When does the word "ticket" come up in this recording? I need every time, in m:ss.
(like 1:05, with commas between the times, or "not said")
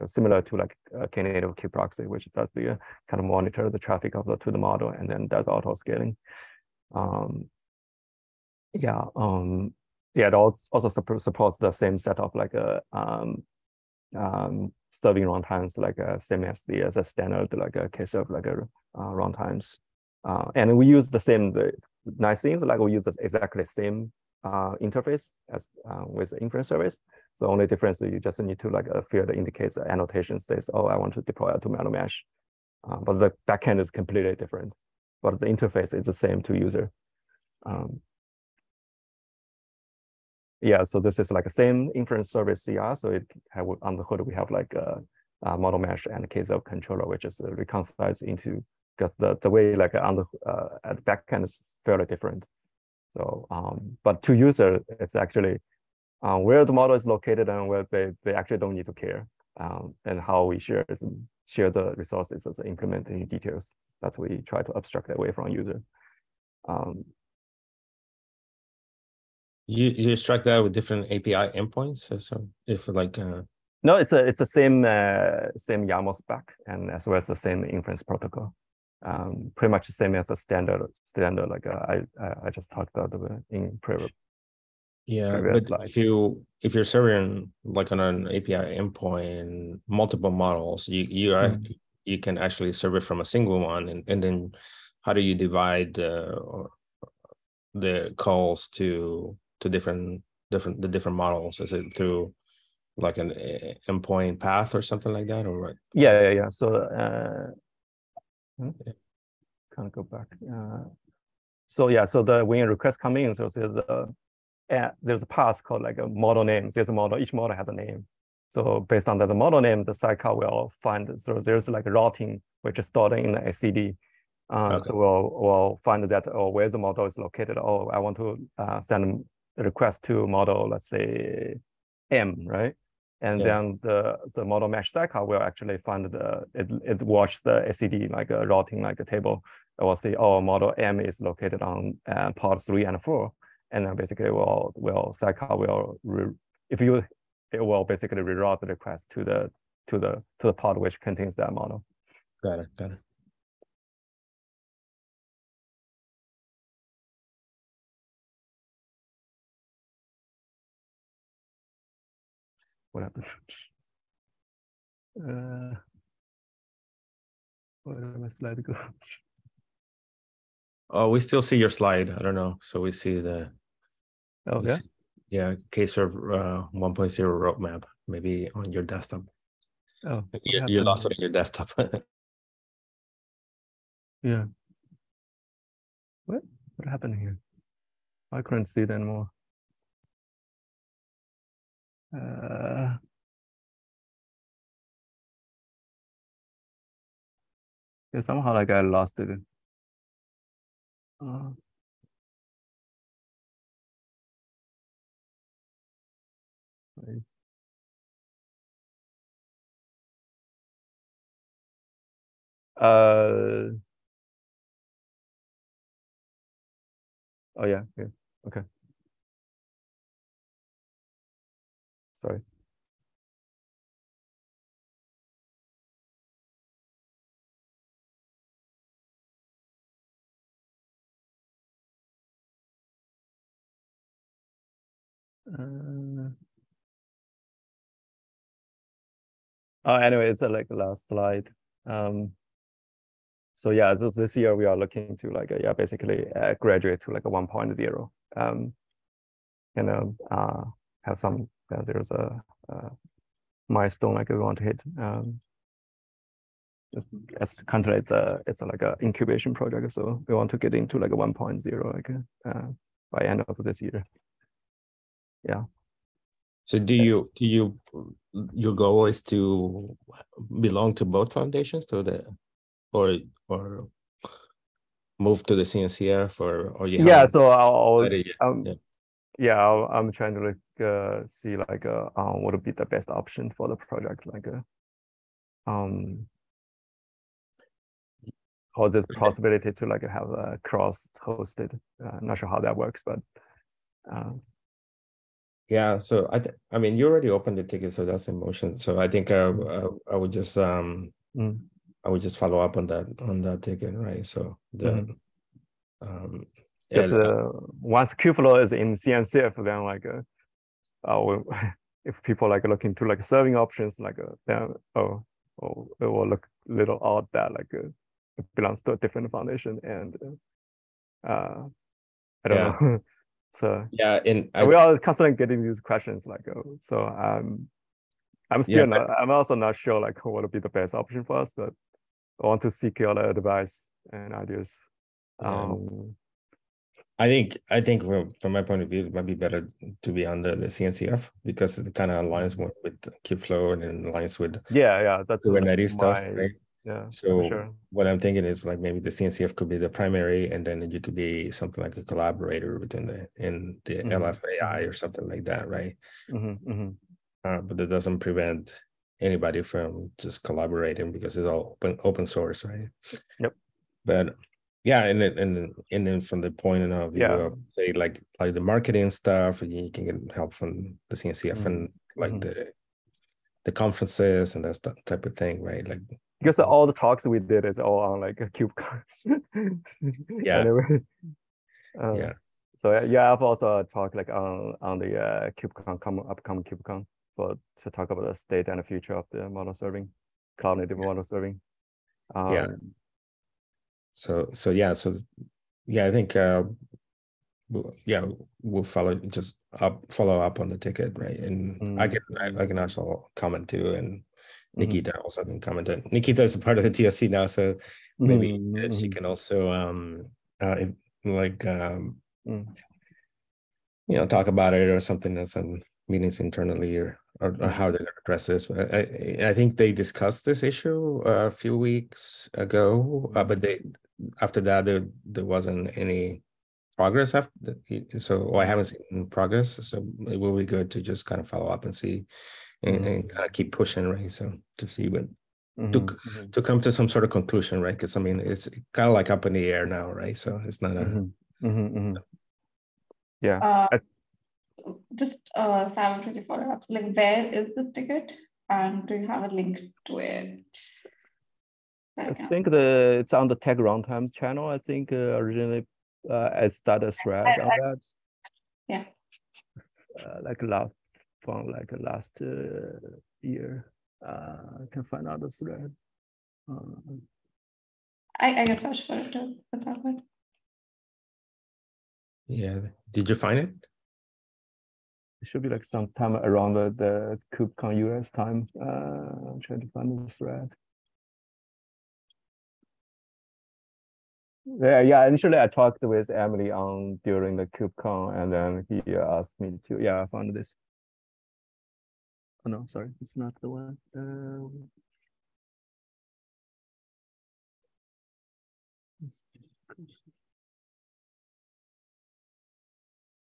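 4:57, 5:03, 6:40, 7:27.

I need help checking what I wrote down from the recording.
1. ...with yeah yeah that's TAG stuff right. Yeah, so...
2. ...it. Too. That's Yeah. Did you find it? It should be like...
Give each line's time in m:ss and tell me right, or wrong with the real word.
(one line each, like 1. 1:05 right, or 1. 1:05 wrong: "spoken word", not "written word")
1. 5:44 wrong: "Kubernetes", not "TAG"
2. 7:49 right.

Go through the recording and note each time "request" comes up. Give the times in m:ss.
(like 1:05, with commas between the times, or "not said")
1:52, 2:09, 2:28.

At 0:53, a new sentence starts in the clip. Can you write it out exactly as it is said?
So, um, but to user, it's actually uh, where the model is located and where they, they actually don't need to care.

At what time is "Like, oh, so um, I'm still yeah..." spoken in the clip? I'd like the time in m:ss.
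5:26.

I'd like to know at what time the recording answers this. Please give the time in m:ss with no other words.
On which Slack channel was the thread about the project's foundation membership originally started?
7:33.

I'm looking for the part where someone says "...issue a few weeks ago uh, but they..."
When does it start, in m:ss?
7:00.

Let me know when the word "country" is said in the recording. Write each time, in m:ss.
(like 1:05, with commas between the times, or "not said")
4:17.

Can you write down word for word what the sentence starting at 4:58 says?
So I think uh, I, mm-hmm.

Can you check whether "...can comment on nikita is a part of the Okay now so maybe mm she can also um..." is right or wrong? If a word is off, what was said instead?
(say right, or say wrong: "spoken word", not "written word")
wrong: "TOC", not "Okay".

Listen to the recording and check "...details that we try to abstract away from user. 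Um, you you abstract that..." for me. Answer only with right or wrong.
wrong.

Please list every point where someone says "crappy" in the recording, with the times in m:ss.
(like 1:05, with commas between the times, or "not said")
not said.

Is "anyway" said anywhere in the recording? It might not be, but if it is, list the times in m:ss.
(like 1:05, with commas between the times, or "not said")
3:59, 6:20.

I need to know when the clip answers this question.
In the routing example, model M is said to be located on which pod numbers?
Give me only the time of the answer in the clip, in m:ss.
2:22.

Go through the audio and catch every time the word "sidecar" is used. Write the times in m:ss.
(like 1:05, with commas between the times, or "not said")
1:59, 2:14, 2:25.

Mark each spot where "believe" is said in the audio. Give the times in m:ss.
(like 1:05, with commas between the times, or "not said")
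not said.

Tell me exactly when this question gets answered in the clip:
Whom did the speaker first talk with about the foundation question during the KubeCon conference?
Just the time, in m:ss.
8:06.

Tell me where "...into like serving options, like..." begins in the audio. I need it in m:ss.
5:12.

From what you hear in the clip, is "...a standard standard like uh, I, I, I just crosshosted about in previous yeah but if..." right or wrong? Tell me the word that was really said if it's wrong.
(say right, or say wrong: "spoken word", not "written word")
wrong: "talked", not "crosshosted".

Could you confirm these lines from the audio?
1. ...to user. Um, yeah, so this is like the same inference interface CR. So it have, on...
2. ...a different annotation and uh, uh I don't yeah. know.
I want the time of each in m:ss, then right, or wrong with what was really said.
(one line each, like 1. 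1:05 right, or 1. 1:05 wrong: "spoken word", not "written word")
1. 0:36 wrong: "service", not "interface"
2. 5:18 wrong: "foundation", not "annotation".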